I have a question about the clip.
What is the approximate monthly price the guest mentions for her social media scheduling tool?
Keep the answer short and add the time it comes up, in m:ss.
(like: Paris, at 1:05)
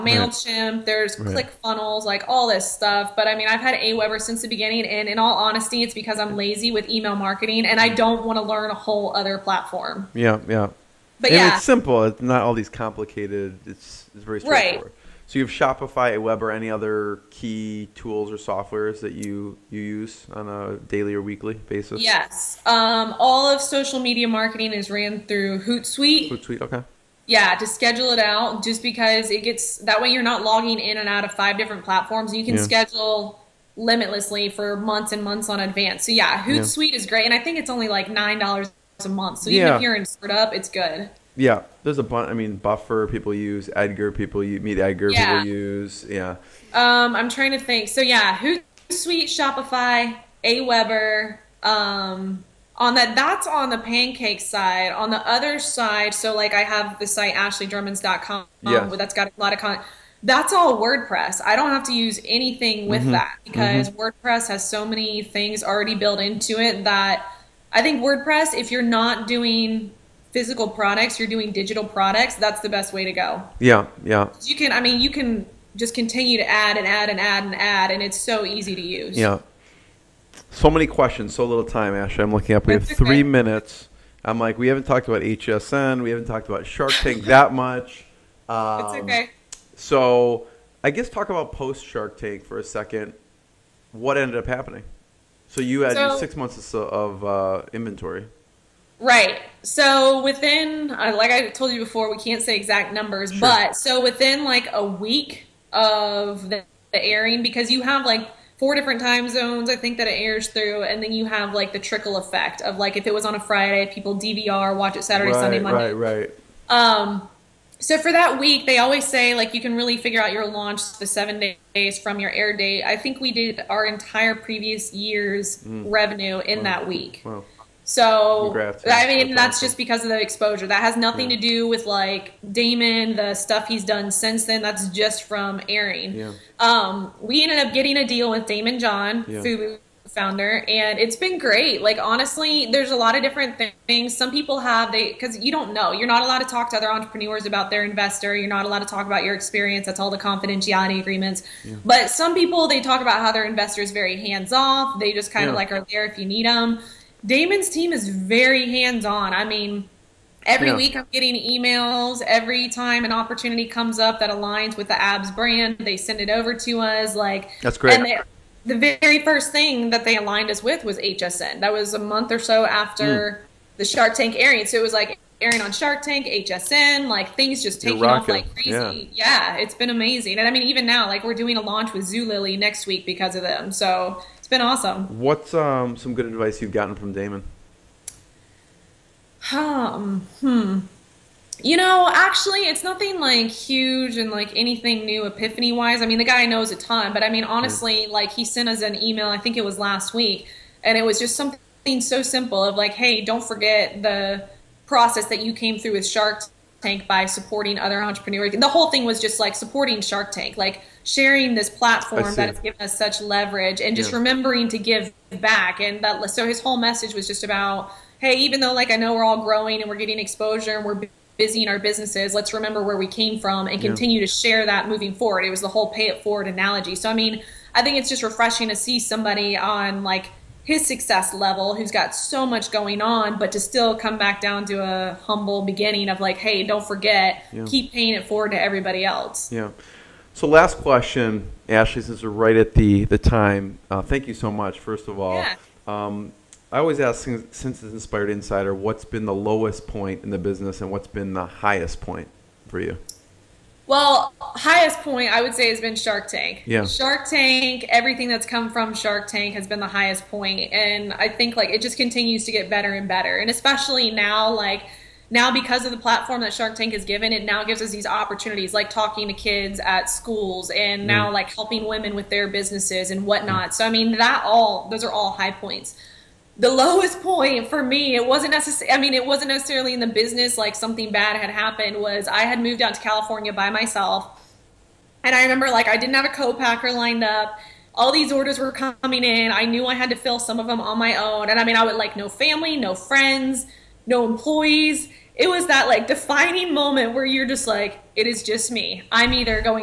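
$9, at 0:38.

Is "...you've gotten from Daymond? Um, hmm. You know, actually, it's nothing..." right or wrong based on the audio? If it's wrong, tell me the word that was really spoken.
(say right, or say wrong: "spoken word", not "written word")
right.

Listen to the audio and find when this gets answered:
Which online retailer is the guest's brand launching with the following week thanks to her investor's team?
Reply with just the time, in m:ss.
3:02.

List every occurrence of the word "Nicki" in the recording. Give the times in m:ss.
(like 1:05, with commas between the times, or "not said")
not said.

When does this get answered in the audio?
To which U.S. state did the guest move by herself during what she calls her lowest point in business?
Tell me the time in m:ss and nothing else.
4:43.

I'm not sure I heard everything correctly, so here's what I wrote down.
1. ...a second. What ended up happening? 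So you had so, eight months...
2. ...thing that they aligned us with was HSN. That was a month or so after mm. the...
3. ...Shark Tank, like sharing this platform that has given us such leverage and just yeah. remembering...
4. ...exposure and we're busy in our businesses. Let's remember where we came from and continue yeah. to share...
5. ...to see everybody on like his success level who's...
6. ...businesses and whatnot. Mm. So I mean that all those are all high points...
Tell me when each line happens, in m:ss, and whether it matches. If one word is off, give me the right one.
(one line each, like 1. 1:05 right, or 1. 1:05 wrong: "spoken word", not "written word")
1. 1:32 wrong: "six", not "eight"
2. 2:49 right
3. 3:30 right
4. 3:40 right
5. 3:48 wrong: "somebody", not "everybody"
6. 4:32 right.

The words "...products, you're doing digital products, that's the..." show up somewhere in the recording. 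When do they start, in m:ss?
1:10.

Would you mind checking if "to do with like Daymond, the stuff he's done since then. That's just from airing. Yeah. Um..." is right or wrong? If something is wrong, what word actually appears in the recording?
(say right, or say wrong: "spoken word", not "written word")
right.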